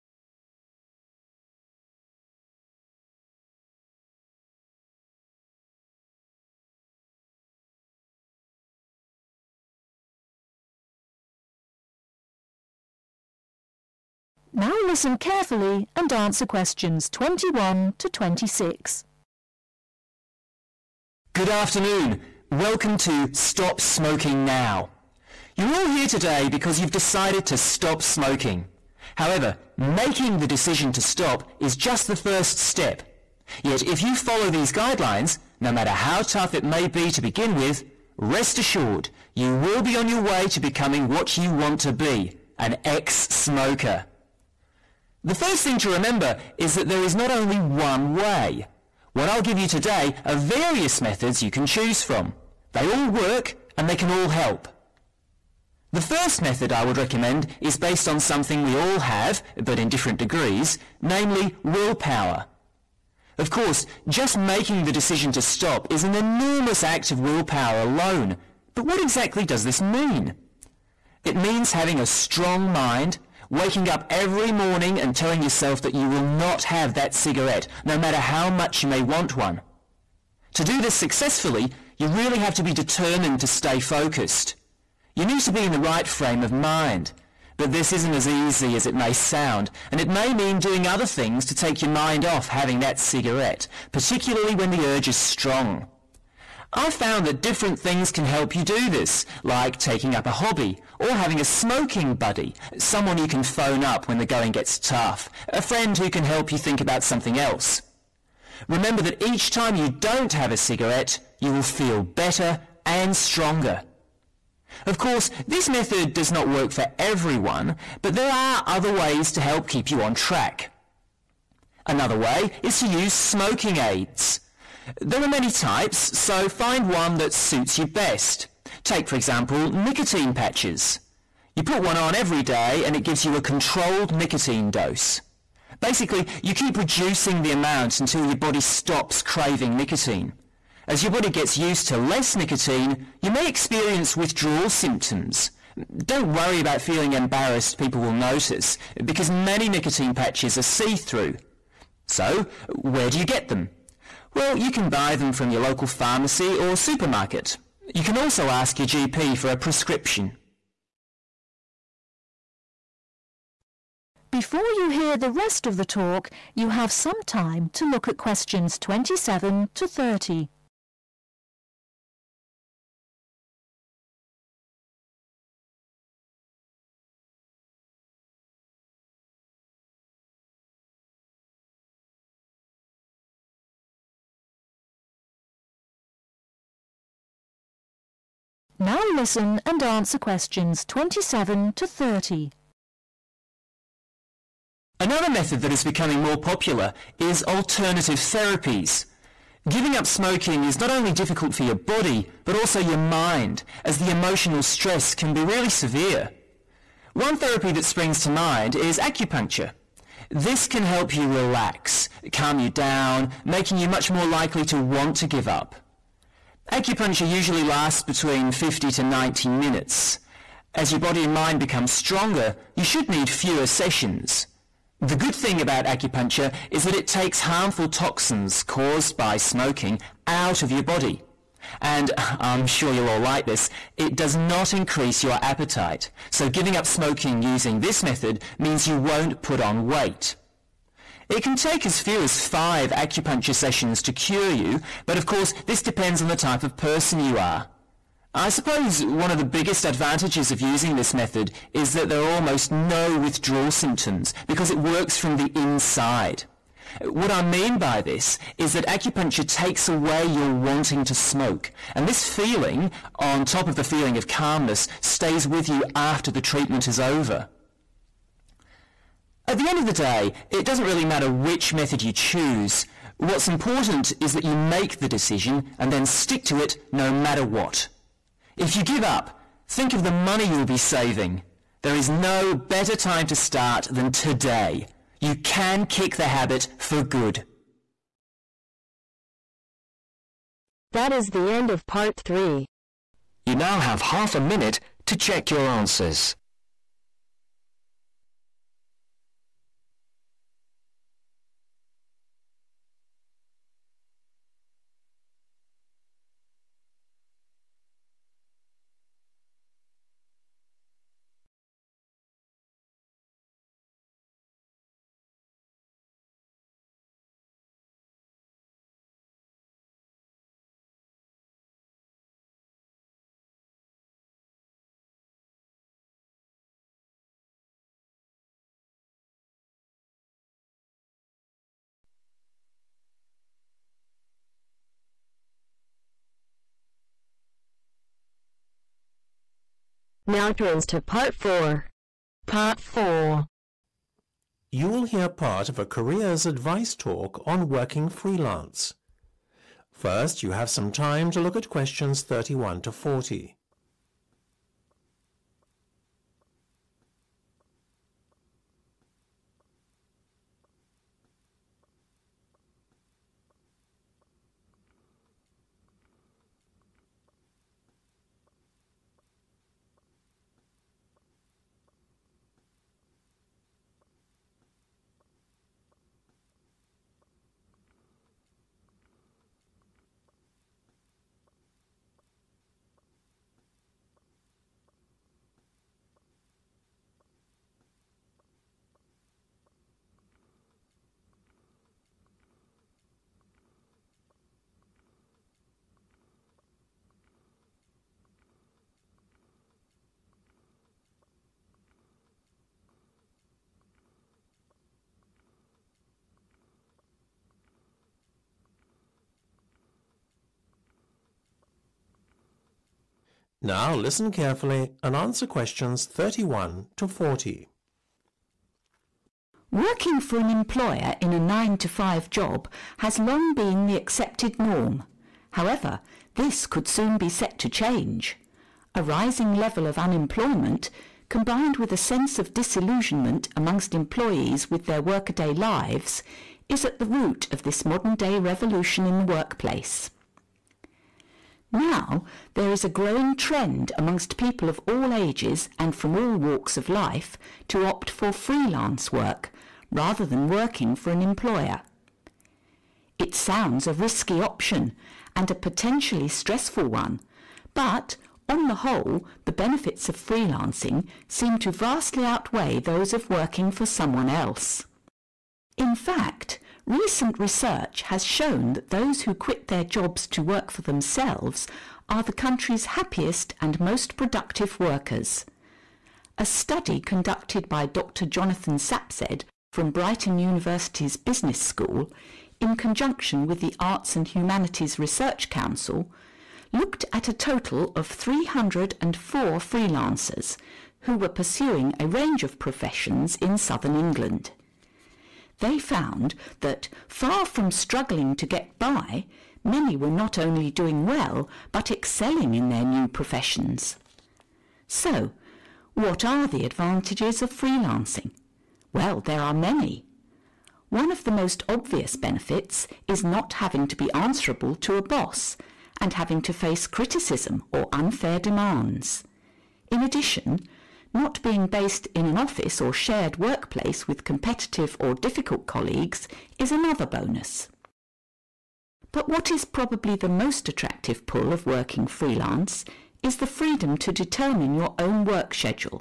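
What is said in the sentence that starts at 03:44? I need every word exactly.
The good thing about acupuncture is that it takes harmful toxins caused by smoking out of your body.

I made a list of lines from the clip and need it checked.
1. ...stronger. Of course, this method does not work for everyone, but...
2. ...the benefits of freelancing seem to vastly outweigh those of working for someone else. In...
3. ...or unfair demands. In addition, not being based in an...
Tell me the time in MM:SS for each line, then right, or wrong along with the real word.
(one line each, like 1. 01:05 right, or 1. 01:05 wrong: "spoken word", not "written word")
1. 01:53 right
2. 07:39 right
3. 08:37 right.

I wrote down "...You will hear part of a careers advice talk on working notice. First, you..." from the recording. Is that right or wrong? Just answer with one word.
wrong.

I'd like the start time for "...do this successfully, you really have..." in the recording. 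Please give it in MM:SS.
01:20.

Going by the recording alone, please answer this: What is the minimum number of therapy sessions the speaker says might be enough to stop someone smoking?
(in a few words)
5.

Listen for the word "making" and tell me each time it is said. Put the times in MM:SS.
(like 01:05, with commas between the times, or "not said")
00:29, 01:04, 03:33.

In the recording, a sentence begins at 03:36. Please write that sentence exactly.
Acupuncture usually lasts between 50 to 90 minutes.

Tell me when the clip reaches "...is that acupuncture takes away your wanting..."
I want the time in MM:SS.
04:18.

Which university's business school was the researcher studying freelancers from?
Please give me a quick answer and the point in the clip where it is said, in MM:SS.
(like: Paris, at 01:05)
Brighton University, at 07:59.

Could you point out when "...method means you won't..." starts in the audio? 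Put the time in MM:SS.
03:58.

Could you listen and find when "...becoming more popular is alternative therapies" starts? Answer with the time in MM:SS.
03:15.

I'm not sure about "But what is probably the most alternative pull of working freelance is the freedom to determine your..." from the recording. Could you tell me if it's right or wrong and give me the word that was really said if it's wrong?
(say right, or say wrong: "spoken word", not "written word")
wrong: "attractive", not "alternative".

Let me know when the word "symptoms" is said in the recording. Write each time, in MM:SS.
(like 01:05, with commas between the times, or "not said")
02:24, 04:13.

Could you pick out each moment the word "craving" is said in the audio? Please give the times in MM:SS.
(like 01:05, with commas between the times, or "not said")
02:19.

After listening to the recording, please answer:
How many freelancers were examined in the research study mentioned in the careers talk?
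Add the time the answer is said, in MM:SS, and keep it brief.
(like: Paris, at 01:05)
304, at 08:08.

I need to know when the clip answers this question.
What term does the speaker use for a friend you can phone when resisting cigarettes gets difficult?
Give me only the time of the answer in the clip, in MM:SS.
01:41.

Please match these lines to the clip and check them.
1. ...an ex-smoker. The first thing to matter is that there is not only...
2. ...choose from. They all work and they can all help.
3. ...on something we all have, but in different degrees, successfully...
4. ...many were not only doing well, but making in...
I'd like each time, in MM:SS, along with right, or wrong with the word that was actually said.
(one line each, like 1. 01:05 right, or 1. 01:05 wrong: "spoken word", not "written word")
1. 00:42 wrong: "remember", not "matter"
2. 00:51 right
3. 00:58 wrong: "namely", not "successfully"
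4. 08:19 wrong: "excelling", not "making".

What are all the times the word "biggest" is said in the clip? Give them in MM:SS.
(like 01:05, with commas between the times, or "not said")
04:09.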